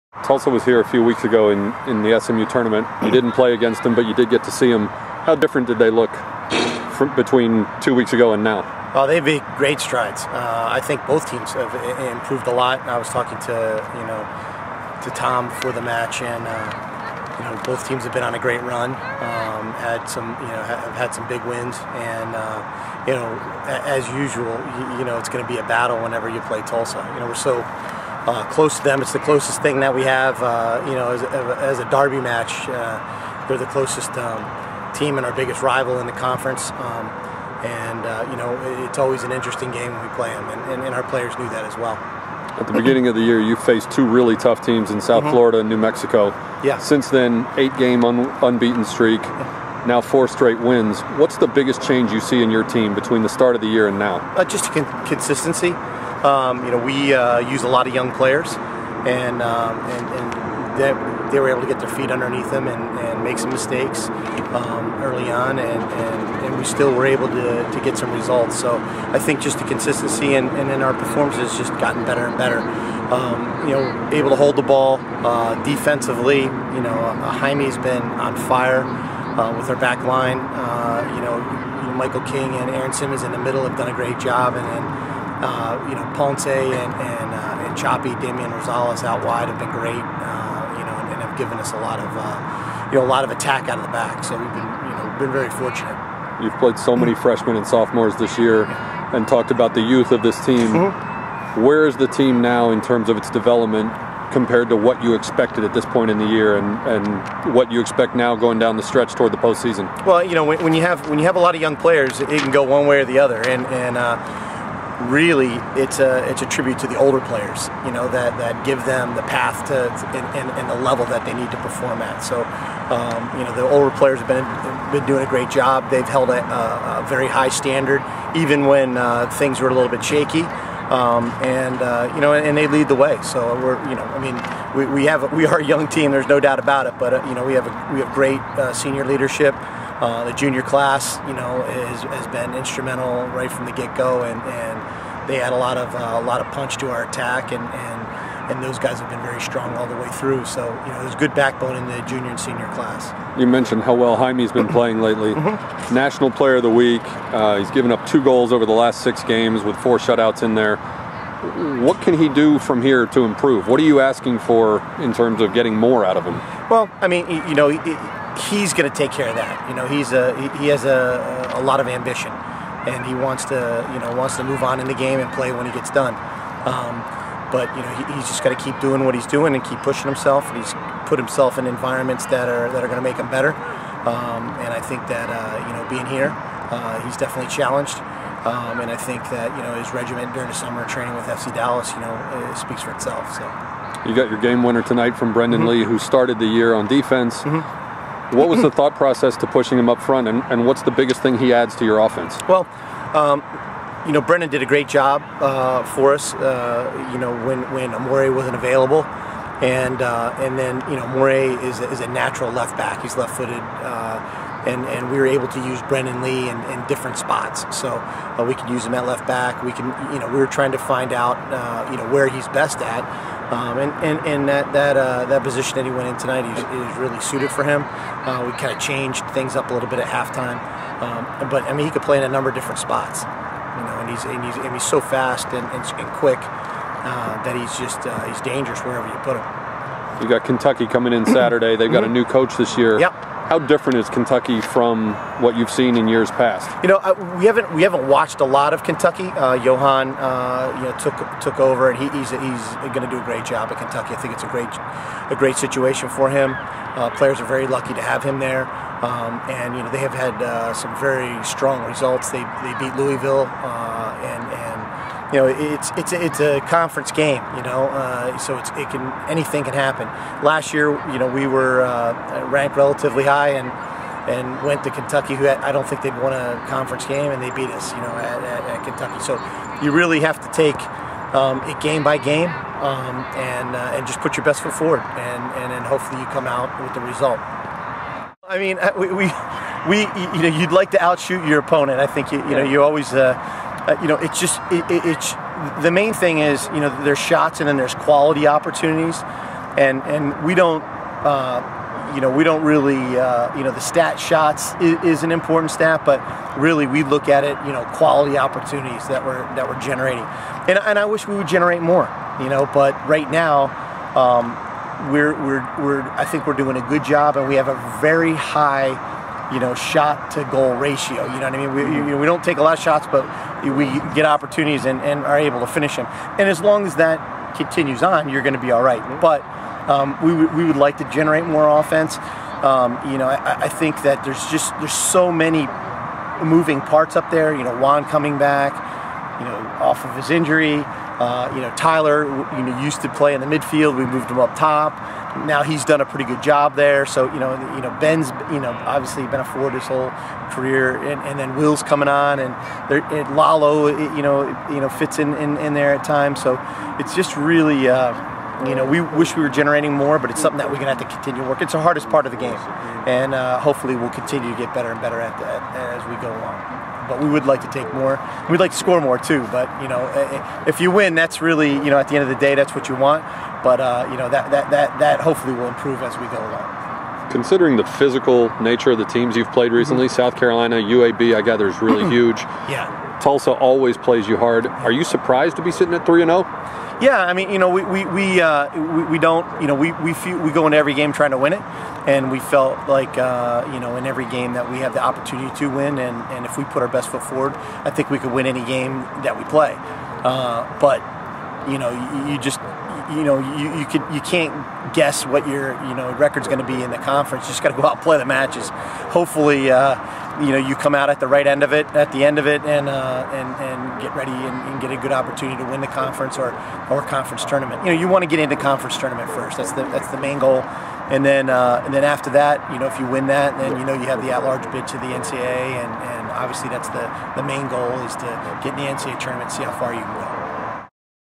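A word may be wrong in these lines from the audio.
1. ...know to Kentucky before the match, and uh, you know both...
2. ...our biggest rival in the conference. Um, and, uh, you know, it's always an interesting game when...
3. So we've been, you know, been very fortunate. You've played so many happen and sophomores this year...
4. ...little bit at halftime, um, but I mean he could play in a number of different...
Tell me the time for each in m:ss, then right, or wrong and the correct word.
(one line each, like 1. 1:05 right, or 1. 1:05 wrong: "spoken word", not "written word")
1. 0:14 wrong: "Tom", not "Kentucky"
2. 0:35 right
3. 1:34 wrong: "freshmen", not "happen"
4. 3:49 right.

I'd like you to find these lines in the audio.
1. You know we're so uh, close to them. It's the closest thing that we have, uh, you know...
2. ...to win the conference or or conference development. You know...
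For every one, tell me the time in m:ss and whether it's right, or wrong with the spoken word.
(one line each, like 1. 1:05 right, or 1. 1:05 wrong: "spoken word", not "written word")
1. 0:27 right
2. 6:55 wrong: "tournament", not "development".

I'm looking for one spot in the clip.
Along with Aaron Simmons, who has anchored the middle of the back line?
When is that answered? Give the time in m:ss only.
1:21.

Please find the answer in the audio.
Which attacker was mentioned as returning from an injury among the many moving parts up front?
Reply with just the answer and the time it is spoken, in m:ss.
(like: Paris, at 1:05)
Juan, at 5:37.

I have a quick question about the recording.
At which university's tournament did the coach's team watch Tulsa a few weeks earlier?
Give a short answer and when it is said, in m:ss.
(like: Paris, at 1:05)
SMU, at 0:02.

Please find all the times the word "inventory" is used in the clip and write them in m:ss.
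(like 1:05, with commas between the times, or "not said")
not said.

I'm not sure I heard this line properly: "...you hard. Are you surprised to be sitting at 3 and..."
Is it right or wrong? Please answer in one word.
right.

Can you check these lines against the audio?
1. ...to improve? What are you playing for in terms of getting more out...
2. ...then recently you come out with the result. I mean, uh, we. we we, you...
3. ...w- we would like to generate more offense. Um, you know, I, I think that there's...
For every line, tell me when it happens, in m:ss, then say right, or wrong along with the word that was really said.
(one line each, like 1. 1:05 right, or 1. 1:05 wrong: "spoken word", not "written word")
1. 2:43 wrong: "asking", not "playing"
2. 4:45 wrong: "hopefully", not "recently"
3. 5:30 right.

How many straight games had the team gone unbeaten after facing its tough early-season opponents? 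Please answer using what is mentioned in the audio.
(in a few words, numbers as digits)
8.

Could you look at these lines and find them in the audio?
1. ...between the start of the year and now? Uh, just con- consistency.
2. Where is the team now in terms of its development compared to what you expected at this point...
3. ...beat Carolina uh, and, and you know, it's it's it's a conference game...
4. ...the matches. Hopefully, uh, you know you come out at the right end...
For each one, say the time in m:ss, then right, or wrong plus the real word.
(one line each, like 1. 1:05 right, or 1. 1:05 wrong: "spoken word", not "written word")
1. 0:52 right
2. 1:41 right
3. 4:22 wrong: "Louisville", not "Carolina"
4. 6:48 right.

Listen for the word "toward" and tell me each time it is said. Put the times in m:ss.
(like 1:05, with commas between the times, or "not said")
1:49.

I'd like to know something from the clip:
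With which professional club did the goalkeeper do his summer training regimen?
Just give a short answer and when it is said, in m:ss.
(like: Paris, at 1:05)
FC Dallas, at 3:11.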